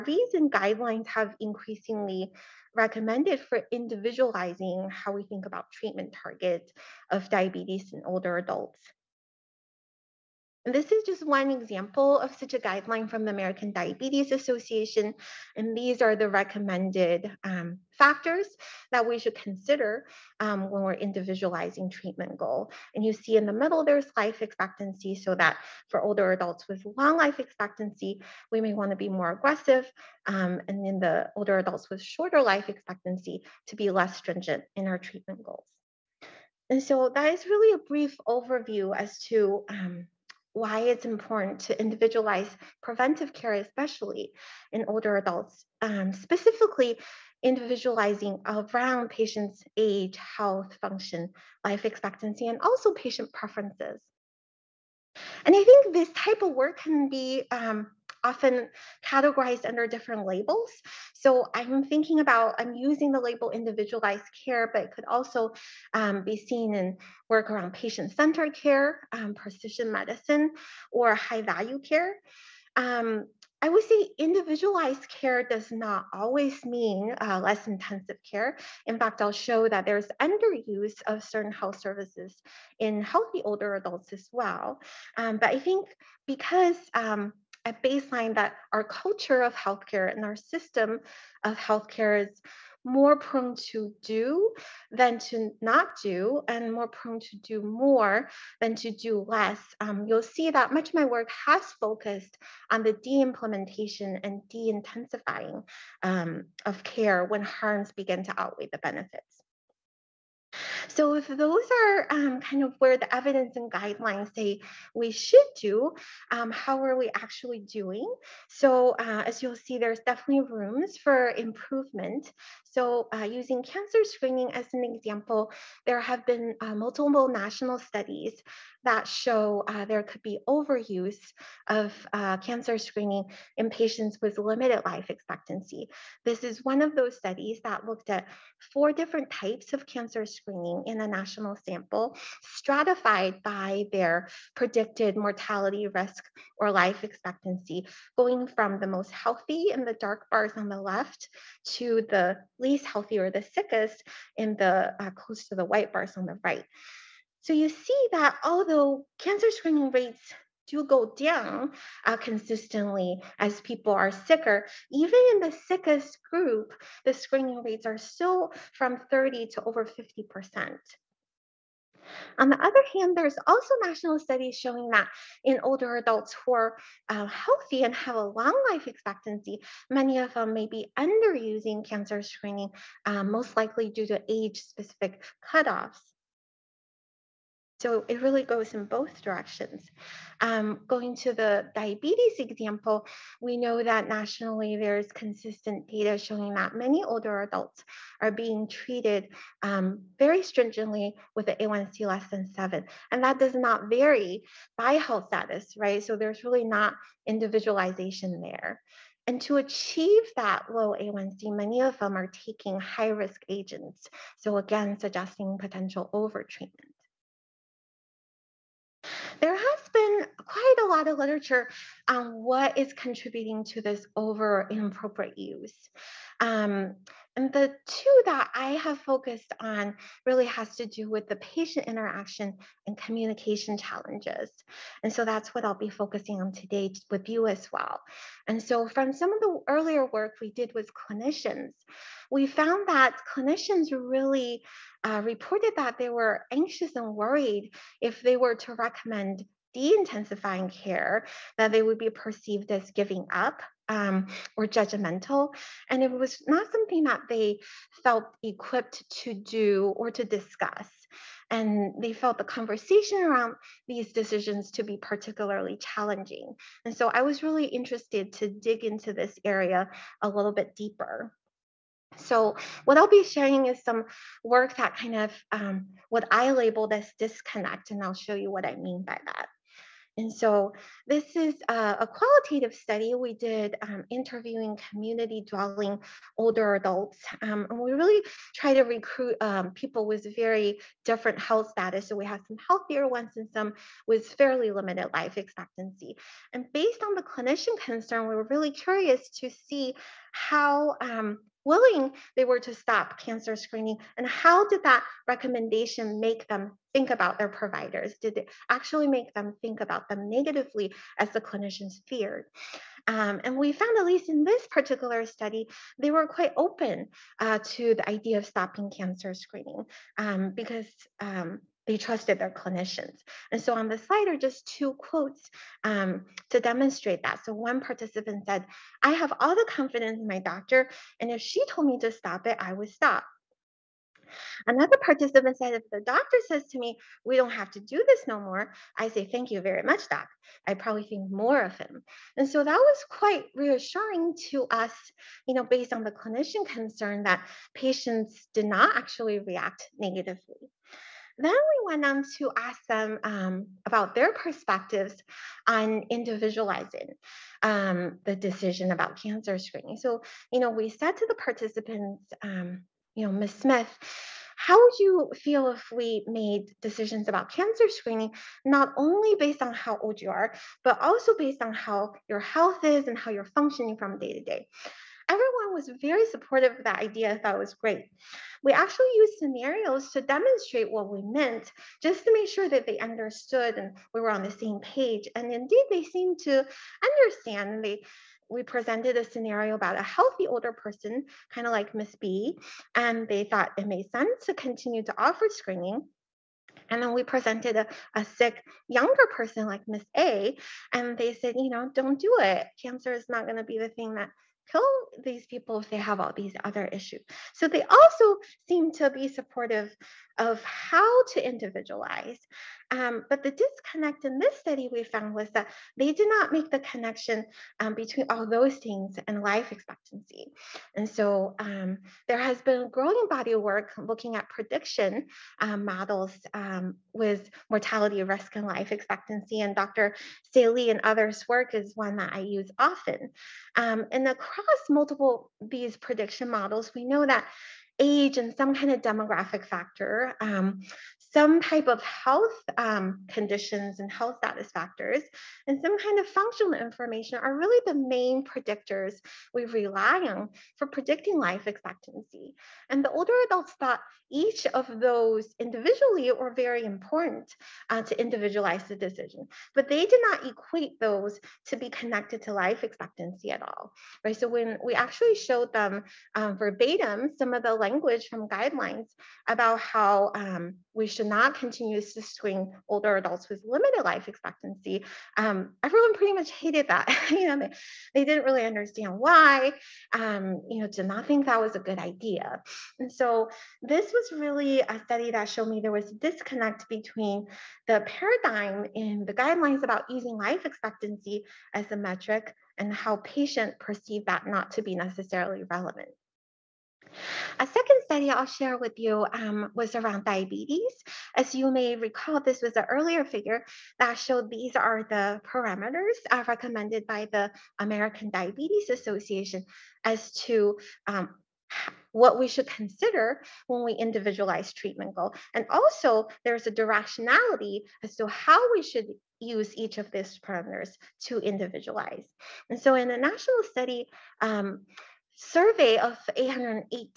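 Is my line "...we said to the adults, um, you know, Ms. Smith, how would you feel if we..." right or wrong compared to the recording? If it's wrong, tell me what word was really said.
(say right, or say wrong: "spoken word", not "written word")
wrong: "participants", not "adults".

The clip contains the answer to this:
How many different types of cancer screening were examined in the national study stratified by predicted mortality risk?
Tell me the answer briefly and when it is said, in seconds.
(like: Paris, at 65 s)
4, at 138 s.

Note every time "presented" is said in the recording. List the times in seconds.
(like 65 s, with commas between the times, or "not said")
388 s, 397 s.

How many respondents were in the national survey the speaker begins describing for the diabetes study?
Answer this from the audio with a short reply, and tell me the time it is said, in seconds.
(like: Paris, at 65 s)
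818, at 526 s.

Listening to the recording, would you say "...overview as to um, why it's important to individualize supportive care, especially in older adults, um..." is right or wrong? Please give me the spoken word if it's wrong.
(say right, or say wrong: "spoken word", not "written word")
wrong: "preventive", not "supportive".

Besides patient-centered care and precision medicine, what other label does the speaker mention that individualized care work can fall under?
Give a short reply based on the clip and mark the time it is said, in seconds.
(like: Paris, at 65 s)
high value care, at 71 s.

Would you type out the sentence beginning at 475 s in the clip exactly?
Um, everyone pretty much hated that.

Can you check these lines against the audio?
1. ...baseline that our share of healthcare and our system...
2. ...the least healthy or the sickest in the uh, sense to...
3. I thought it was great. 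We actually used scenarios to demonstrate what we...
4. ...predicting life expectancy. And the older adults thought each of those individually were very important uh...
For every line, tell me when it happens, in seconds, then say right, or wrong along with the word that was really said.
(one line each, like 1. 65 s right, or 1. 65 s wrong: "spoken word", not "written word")
1. 87 s wrong: "culture", not "share"
2. 152 s wrong: "close", not "sense"
3. 377 s right
4. 450 s right.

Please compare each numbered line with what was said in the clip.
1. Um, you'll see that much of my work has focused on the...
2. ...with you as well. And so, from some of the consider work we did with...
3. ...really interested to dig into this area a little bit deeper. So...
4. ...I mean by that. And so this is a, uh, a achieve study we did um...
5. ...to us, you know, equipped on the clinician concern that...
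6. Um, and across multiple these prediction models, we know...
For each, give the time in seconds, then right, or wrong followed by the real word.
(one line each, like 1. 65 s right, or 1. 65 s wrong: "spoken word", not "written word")
1. 99 s right
2. 237 s wrong: "earlier", not "consider"
3. 267 s right
4. 278 s wrong: "qualitative", not "achieve"
5. 344 s wrong: "based", not "equipped"
6. 433 s right.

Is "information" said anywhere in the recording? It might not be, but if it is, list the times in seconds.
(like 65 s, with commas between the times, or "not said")
446 s.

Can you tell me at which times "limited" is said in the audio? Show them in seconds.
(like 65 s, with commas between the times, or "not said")
134 s, 294 s, 473 s.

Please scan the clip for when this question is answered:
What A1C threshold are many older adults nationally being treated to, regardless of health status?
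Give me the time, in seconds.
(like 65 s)
202 s.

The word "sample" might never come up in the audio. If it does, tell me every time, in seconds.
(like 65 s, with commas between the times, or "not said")
141 s.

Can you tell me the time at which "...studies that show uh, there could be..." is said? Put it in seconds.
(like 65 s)
127 s.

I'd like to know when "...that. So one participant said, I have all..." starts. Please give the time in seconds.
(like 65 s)
327 s.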